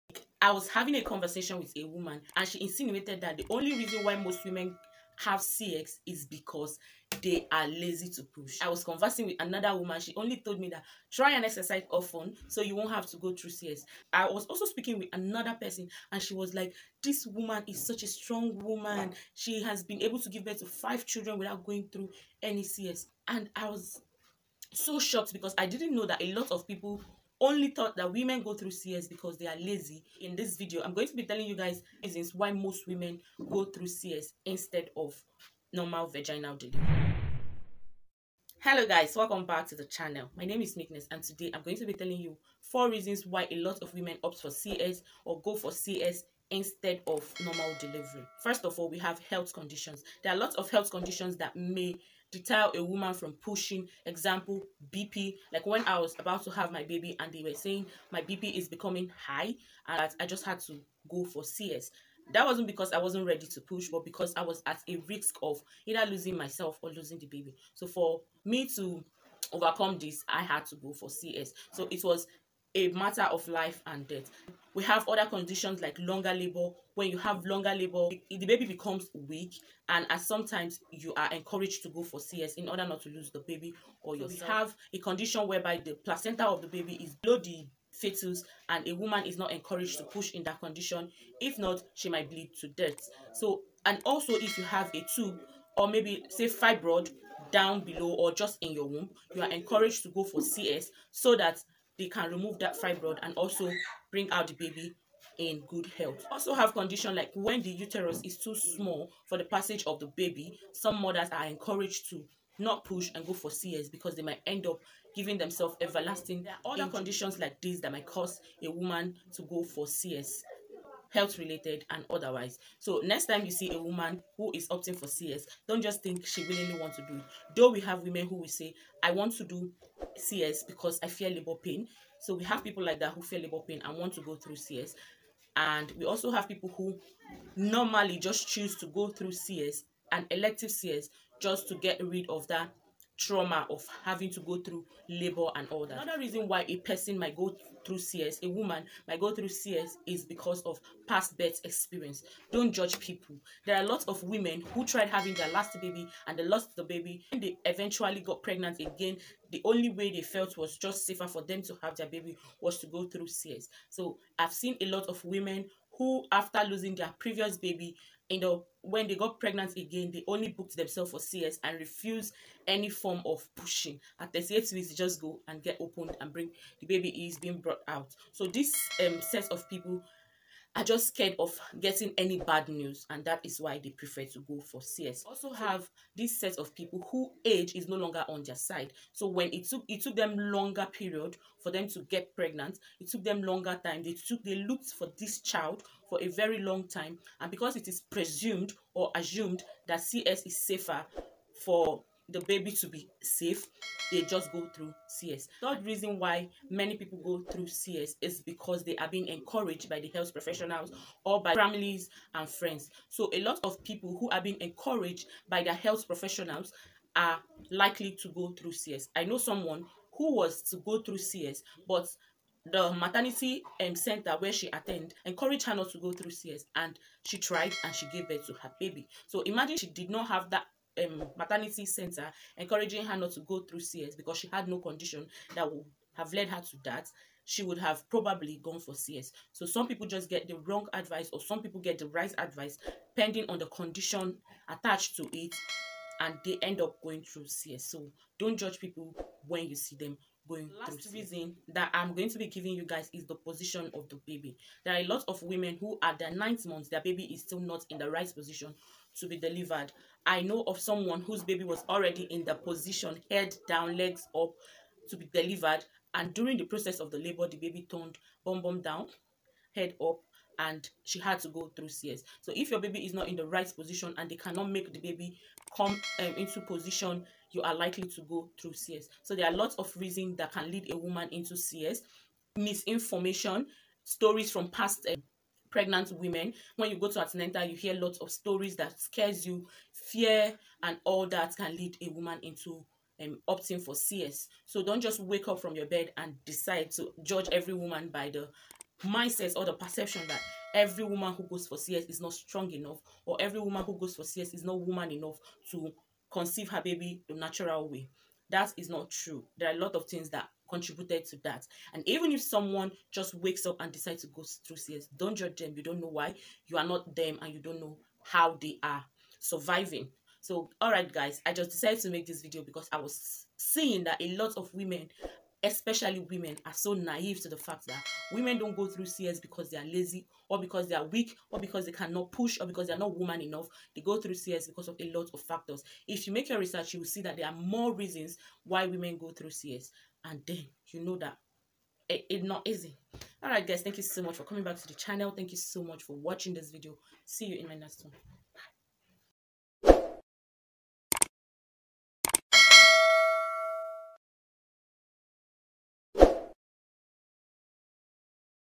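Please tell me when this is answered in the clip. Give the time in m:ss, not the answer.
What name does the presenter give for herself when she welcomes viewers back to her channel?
0:40.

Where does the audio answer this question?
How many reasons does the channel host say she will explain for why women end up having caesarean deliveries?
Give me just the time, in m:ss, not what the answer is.
0:42.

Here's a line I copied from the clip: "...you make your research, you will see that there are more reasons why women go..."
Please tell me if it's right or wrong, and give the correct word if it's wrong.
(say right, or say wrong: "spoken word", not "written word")
right.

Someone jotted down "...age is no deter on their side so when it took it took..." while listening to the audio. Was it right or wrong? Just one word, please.
wrong.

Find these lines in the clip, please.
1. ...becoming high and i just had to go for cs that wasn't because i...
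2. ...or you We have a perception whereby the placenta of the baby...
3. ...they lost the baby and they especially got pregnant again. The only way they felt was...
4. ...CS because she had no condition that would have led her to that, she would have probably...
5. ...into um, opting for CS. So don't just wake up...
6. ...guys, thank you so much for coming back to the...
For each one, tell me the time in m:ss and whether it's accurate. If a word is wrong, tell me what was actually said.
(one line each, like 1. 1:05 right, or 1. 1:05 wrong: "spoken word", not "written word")
1. 0:58 right
2. 1:24 wrong: "condition", not "perception"
3. 2:36 wrong: "eventually", not "especially"
4. 3:53 right
5. 4:52 right
6. 5:43 right.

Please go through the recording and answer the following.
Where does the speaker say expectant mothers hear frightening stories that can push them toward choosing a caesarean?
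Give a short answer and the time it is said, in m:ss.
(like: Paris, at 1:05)
Antenatal, at 4:47.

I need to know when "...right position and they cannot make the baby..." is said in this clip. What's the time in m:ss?
4:33.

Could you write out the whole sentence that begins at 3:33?
So a lot of people who are being encouraged by their health professionals are likely to go through CS.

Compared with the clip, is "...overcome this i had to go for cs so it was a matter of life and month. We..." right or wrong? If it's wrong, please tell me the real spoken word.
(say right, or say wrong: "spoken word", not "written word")
wrong: "death", not "month".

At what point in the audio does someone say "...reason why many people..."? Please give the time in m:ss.
3:25.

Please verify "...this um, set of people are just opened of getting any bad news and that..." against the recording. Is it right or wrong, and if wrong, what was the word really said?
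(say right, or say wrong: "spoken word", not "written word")
wrong: "scared", not "opened".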